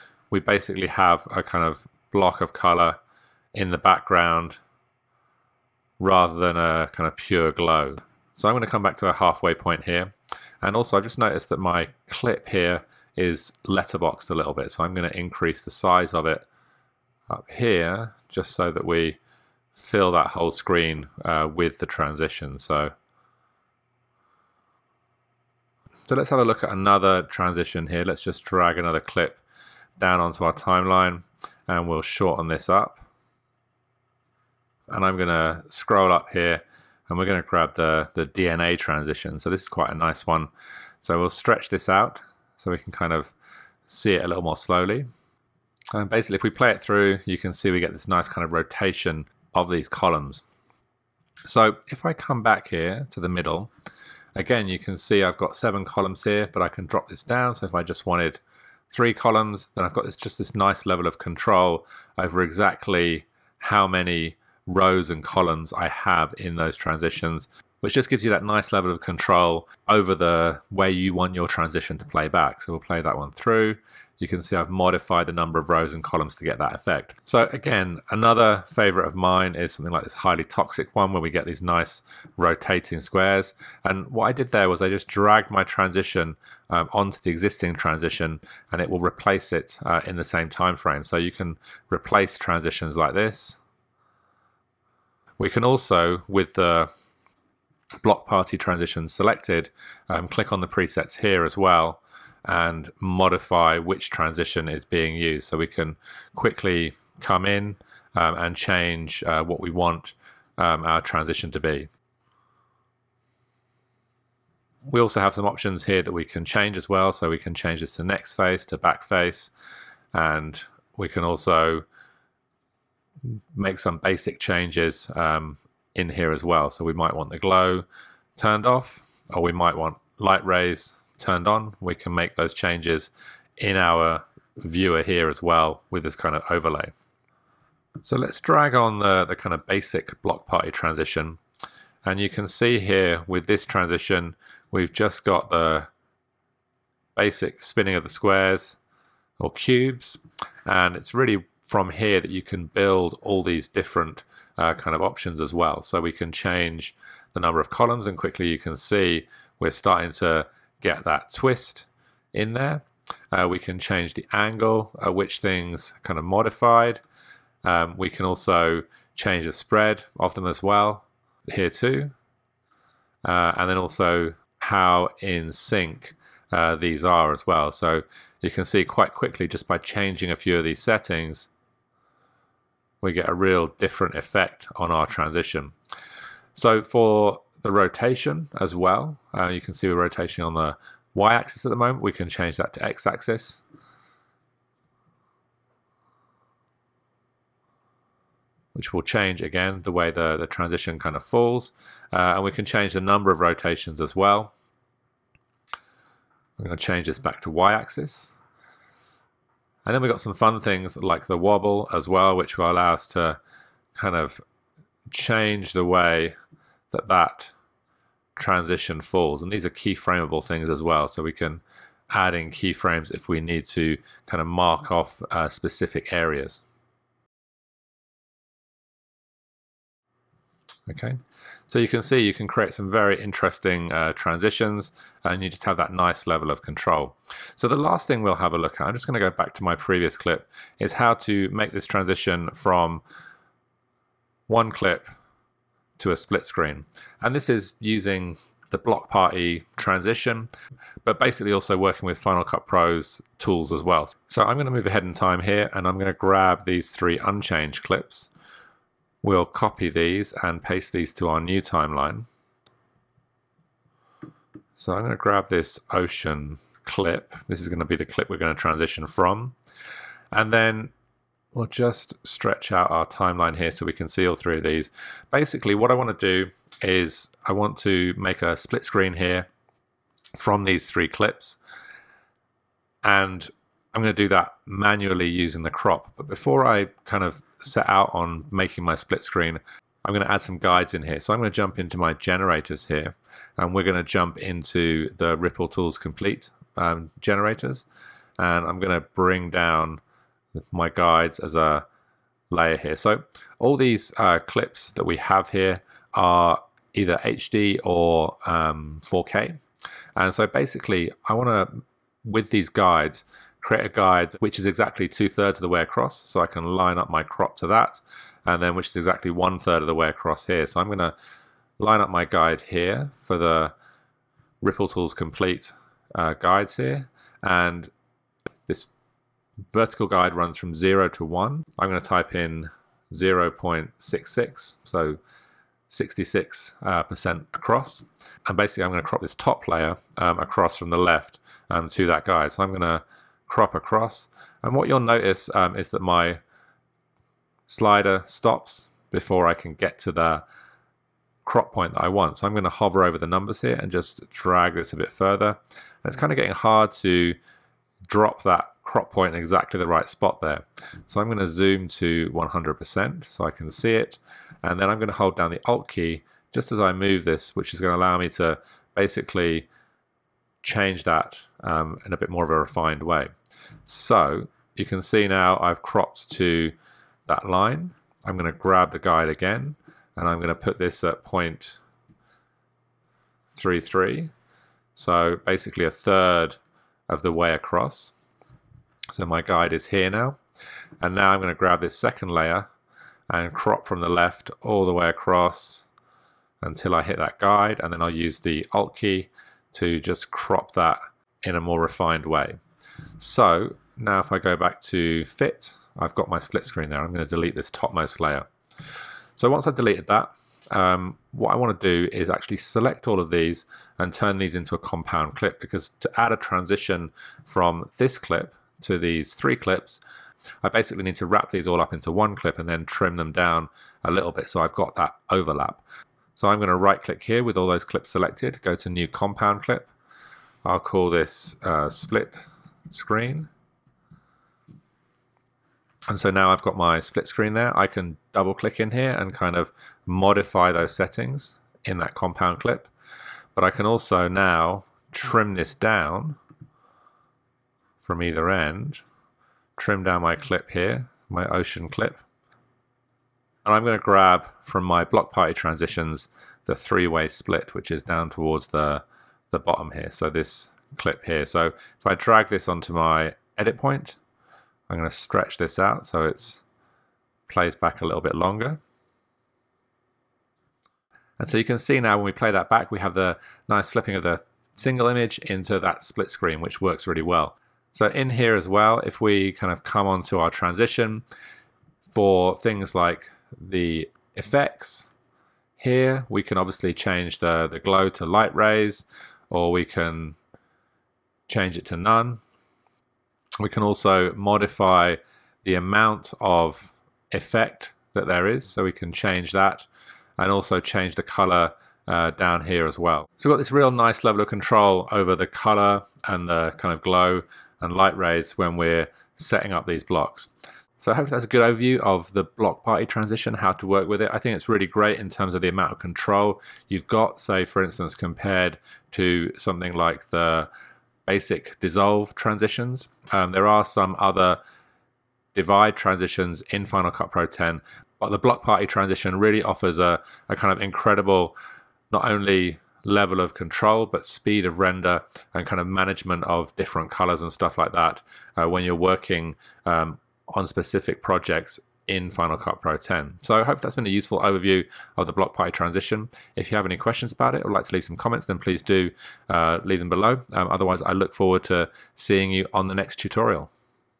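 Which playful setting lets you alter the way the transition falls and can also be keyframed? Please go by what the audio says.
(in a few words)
Wobble.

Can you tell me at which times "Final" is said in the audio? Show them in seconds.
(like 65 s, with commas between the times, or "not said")
252 s, 526 s, 542 s.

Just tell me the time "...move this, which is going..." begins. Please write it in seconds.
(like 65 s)
366 s.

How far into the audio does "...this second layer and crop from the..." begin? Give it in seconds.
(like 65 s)
391 s.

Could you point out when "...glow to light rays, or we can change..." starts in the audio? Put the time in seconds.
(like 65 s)
487 s.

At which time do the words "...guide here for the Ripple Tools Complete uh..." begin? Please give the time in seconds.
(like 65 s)
322 s.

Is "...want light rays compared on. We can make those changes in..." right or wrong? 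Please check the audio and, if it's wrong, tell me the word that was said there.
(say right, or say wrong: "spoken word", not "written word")
wrong: "turned", not "compared".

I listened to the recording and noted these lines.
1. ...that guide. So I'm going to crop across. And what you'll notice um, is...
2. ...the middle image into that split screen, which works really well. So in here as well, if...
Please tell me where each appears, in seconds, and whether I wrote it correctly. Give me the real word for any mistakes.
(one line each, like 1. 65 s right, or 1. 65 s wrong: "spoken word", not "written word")
1. 342 s right
2. 474 s wrong: "single", not "middle".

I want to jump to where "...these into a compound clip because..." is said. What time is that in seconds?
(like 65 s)
414 s.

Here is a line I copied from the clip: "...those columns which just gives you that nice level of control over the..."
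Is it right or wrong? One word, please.
wrong.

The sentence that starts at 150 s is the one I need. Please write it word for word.
And it's really from here that you can build all these different uh, kind of options as well.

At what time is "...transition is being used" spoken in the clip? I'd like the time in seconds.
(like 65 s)
104 s.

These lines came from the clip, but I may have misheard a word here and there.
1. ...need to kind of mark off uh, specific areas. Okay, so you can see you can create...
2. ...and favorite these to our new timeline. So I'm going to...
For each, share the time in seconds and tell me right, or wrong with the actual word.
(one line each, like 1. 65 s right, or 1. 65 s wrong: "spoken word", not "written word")
1. 223 s right
2. 260 s wrong: "paste", not "favorite".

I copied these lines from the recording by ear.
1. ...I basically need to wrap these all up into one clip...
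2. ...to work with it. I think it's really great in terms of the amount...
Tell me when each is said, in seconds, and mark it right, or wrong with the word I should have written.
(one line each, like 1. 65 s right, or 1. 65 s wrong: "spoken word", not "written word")
1. 420 s right
2. 513 s right.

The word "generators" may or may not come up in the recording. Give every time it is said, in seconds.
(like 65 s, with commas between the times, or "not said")
292 s, 297 s.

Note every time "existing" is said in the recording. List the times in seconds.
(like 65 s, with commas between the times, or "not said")
87 s.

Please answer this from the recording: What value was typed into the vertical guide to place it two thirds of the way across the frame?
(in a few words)
0.66.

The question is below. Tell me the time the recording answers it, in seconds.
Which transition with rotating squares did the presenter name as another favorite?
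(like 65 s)
80 s.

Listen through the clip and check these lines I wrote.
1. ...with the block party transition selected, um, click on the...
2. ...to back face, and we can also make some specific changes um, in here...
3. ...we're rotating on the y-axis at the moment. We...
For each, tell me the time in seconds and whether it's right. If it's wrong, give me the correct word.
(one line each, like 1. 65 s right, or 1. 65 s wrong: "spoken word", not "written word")
1. 96 s right
2. 118 s wrong: "basic", not "specific"
3. 189 s right.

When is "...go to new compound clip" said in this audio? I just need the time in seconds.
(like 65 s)
428 s.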